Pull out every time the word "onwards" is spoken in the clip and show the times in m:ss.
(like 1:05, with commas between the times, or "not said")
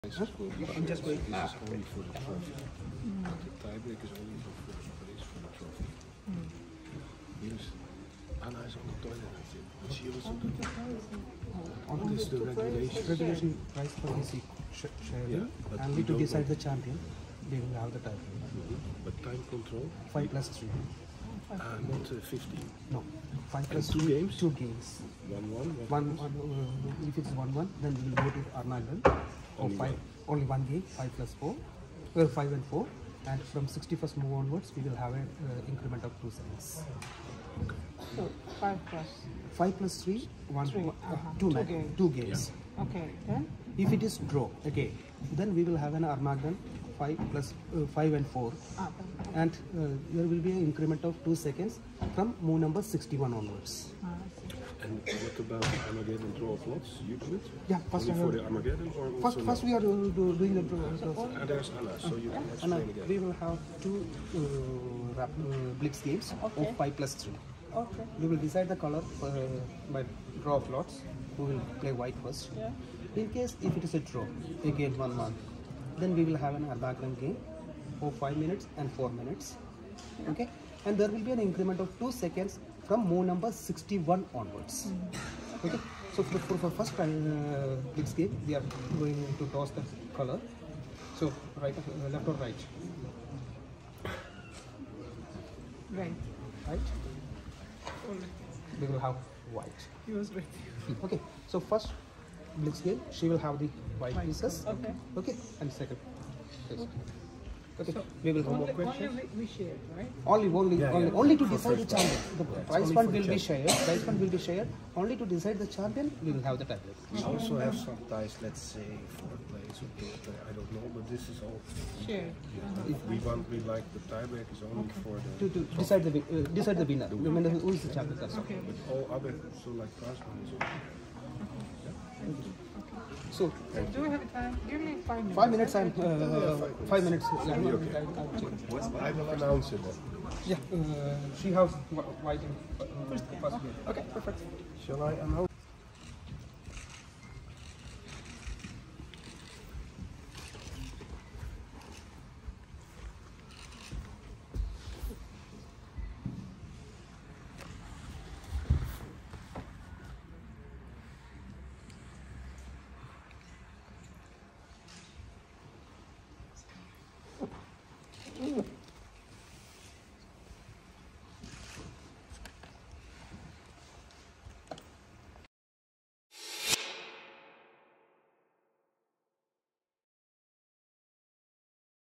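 0:34, 0:53, 1:24.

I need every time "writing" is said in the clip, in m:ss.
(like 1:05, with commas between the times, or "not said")
2:22.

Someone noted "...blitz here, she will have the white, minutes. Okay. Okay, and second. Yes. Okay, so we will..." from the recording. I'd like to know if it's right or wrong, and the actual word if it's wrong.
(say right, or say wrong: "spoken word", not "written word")
wrong: "pieces", not "minutes".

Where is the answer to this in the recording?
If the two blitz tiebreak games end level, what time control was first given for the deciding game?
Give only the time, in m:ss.
0:30.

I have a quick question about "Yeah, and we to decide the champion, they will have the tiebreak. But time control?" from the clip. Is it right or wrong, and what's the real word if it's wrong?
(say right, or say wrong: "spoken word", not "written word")
right.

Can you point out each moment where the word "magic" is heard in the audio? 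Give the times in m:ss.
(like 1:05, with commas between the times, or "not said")
not said.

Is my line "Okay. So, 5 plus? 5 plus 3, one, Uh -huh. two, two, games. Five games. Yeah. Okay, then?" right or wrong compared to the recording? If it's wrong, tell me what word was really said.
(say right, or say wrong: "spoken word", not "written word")
wrong: "Two", not "Five".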